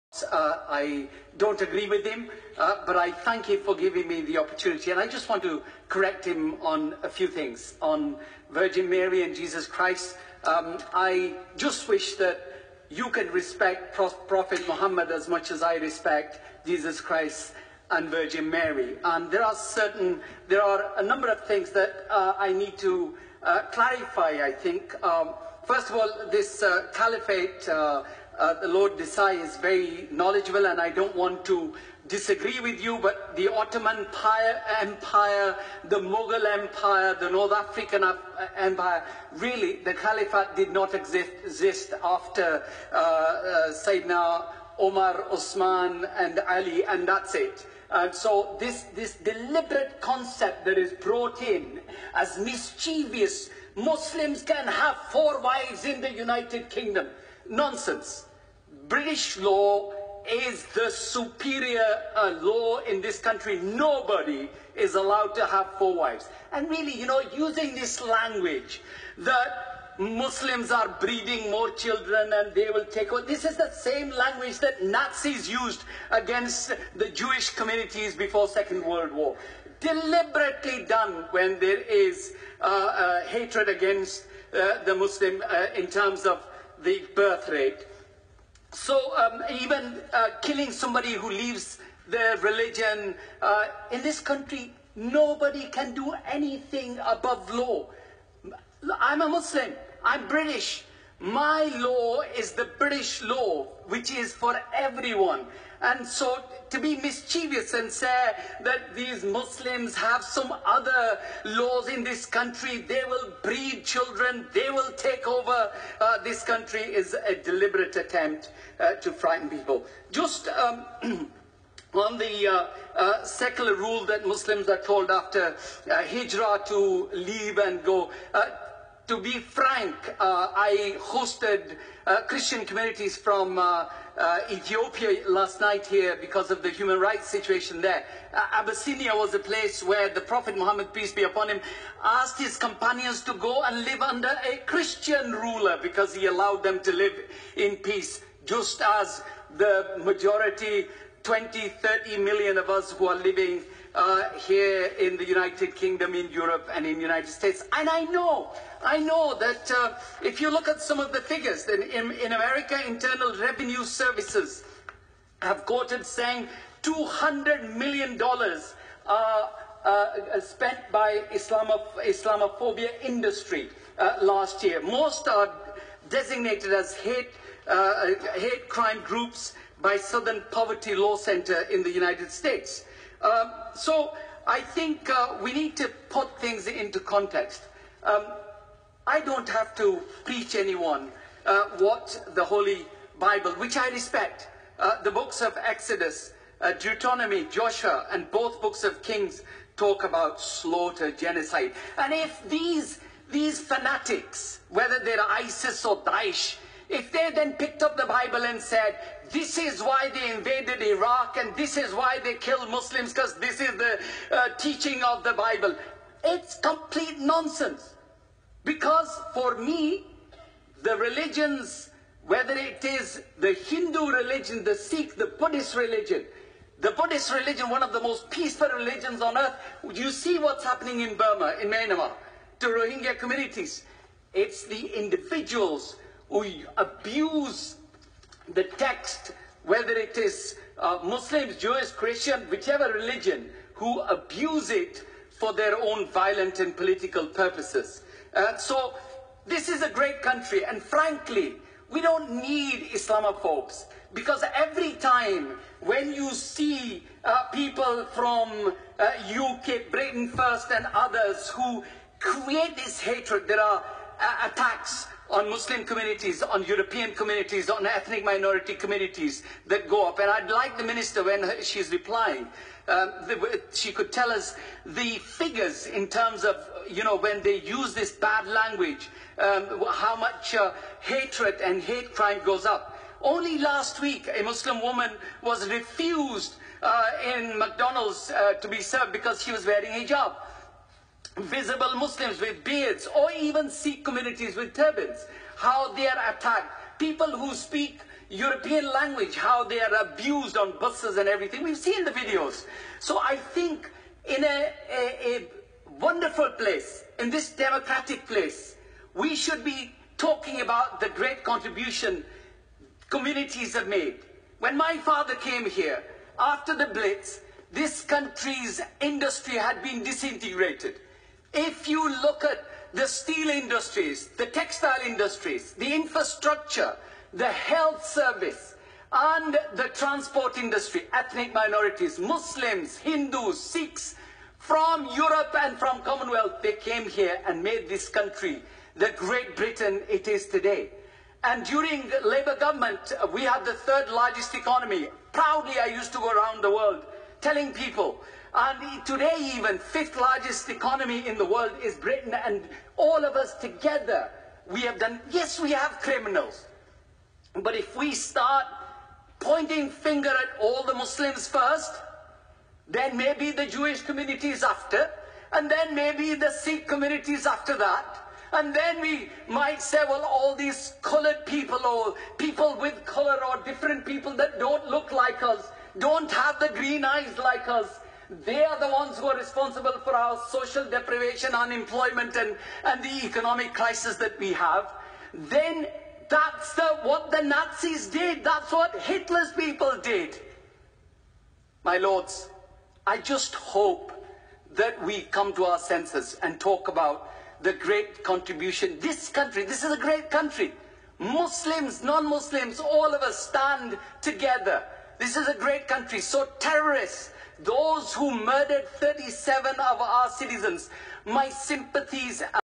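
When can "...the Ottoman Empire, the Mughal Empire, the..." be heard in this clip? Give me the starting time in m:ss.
0:33.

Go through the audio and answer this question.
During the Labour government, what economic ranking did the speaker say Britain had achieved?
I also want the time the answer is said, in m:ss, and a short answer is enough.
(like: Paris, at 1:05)
third largest economy, at 5:43.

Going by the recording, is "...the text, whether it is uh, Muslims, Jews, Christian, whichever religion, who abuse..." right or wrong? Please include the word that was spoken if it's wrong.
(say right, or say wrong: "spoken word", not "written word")
right.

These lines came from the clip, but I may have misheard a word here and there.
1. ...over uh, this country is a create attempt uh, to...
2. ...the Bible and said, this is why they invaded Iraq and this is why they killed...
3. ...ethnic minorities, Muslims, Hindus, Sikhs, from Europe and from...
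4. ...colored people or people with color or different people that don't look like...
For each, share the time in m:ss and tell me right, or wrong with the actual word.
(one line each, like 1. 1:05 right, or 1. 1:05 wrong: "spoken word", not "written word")
1. 1:55 wrong: "deliberate", not "create"
2. 3:27 right
3. 5:31 right
4. 6:11 right.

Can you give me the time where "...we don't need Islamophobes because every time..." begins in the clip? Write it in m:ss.
4:11.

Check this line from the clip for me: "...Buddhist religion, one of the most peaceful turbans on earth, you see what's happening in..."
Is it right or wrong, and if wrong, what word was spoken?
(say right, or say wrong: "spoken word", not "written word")
wrong: "religions", not "turbans".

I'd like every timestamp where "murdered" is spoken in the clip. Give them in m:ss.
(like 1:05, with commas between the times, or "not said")
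6:48.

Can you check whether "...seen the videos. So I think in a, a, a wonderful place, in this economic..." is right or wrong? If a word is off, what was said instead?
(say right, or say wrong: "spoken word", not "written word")
wrong: "democratic", not "economic".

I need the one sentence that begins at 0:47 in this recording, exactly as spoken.
And so this, this deliberate concept that is brought in as mischievous, Muslims can have four wives in the United Kingdom.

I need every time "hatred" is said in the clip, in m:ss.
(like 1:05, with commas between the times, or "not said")
1:23, 4:23, 4:40.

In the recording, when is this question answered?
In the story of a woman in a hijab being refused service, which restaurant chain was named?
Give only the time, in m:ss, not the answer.
4:47.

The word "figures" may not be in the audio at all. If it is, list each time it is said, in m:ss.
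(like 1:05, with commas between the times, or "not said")
2:41, 4:35.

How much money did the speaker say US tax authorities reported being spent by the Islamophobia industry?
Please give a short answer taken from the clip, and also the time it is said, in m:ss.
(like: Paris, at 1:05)
$200 million, at 2:46.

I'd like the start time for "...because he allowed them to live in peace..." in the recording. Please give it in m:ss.
2:25.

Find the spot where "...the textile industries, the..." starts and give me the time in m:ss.
5:24.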